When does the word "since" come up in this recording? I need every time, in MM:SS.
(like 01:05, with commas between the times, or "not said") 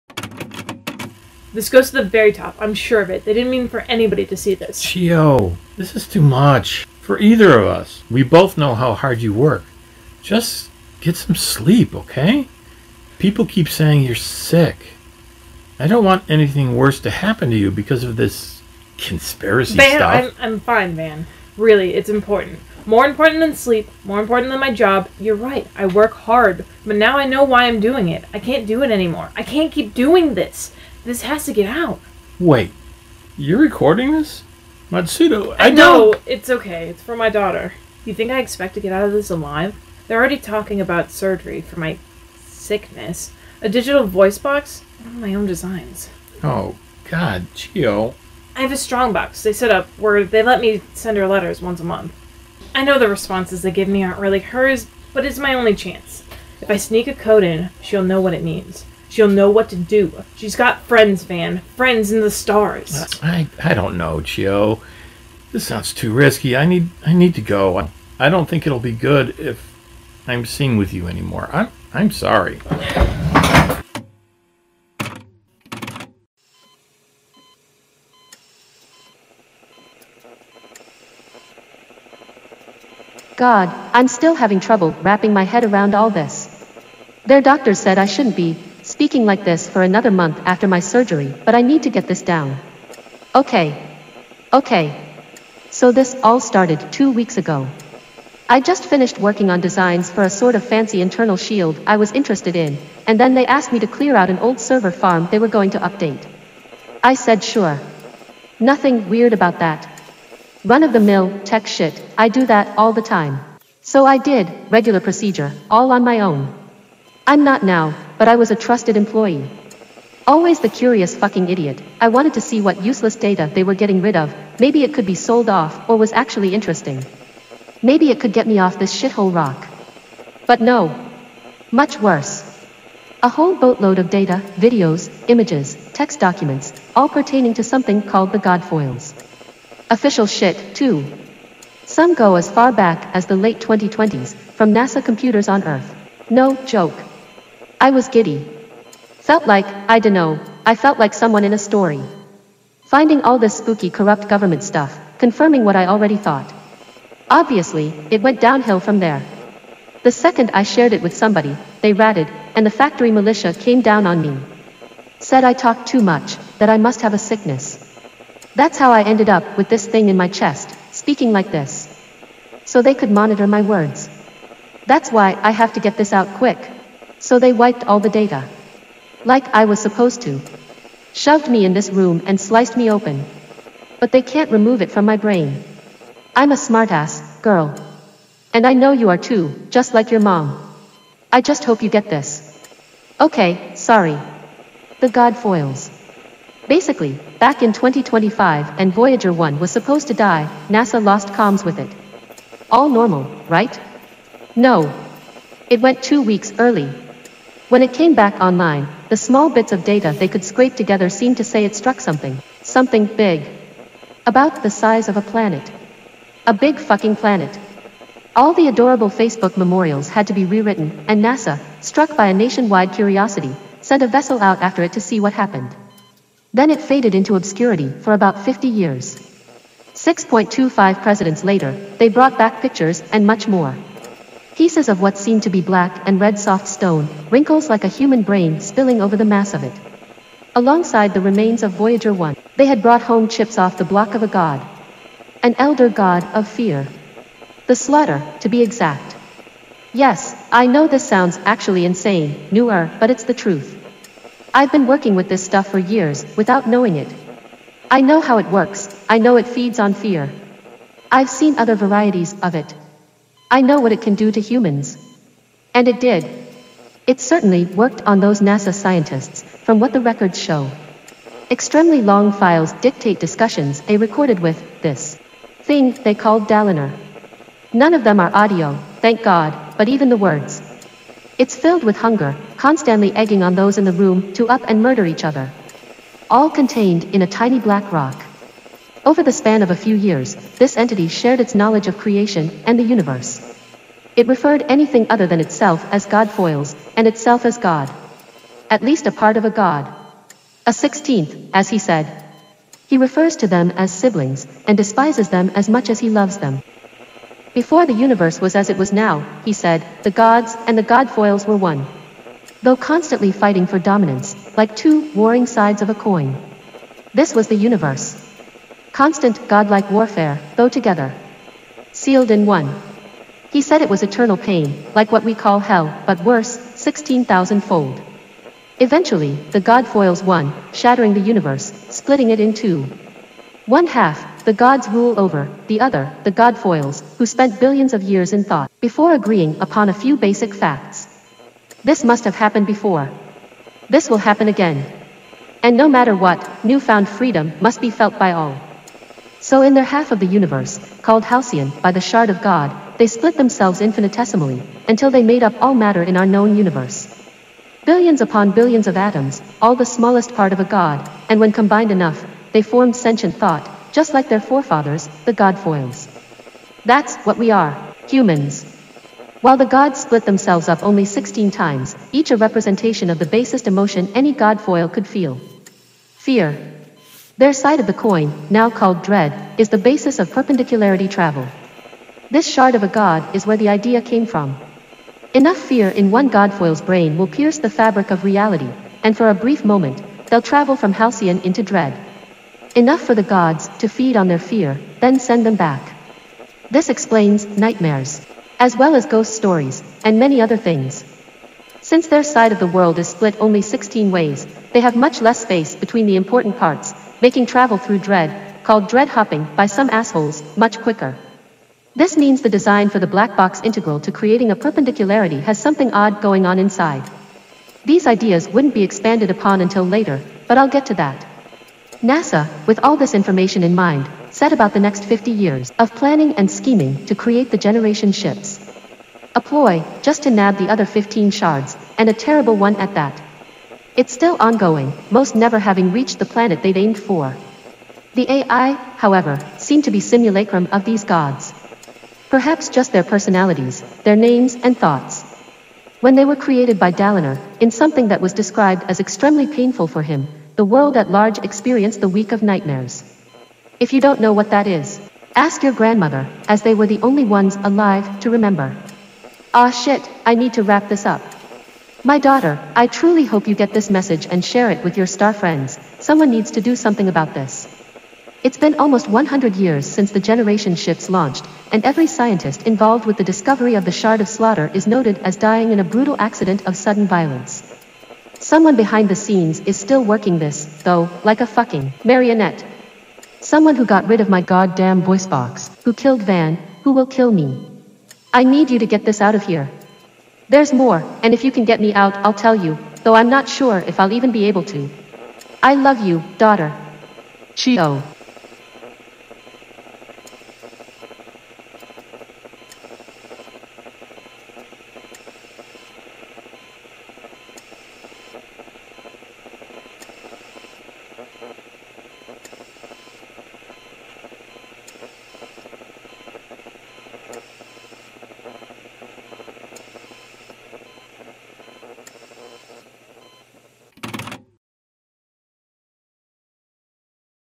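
06:41, 07:49.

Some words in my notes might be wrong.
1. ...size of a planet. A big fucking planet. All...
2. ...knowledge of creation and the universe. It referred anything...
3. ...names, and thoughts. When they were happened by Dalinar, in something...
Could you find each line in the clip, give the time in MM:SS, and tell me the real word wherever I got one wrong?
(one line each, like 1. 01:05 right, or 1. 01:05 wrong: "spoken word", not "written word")
1. 03:34 right
2. 04:51 right
3. 07:24 wrong: "created", not "happened".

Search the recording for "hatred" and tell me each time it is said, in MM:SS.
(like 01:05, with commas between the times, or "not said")
not said.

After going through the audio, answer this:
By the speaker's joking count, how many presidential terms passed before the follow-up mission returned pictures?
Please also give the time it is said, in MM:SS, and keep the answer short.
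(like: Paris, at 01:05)
6.25, at 03:49.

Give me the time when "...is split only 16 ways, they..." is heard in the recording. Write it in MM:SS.
06:42.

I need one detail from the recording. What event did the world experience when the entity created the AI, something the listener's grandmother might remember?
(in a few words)
The week of nightmares.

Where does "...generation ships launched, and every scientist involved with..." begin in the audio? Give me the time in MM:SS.
07:50.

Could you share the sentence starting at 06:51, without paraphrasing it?
This means the design for the black box integral to creating a perpendicularity has something odd going on inside.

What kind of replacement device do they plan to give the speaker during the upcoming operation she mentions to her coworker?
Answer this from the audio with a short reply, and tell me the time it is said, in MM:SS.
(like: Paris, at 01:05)
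Digital voice box, at 00:43.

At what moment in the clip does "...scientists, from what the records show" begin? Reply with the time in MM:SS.
04:28.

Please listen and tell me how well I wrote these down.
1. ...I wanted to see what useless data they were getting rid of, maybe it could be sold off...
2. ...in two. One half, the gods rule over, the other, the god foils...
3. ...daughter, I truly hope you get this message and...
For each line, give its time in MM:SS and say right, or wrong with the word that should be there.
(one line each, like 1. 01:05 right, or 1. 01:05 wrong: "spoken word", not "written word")
1. 02:01 right
2. 05:32 right
3. 07:42 right.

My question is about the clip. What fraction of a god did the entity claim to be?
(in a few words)
A sixteenth.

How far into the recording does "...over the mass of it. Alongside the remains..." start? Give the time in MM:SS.
03:59.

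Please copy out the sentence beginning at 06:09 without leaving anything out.
While the gods split themselves up only 16 times, each a representation of the basest emotion any godfoil could feel.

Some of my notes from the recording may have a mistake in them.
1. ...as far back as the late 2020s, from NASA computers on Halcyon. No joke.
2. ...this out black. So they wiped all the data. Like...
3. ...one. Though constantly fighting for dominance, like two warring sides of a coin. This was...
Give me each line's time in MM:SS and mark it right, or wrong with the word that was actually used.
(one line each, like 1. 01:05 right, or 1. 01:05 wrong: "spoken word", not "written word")
1. 02:22 wrong: "Earth", not "Halcyon"
2. 02:55 wrong: "quick", not "black"
3. 05:11 right.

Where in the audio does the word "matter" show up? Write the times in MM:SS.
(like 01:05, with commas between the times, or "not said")
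05:45, 05:55.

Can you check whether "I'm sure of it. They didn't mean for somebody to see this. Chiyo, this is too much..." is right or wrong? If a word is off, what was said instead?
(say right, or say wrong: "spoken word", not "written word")
wrong: "anybody", not "somebody".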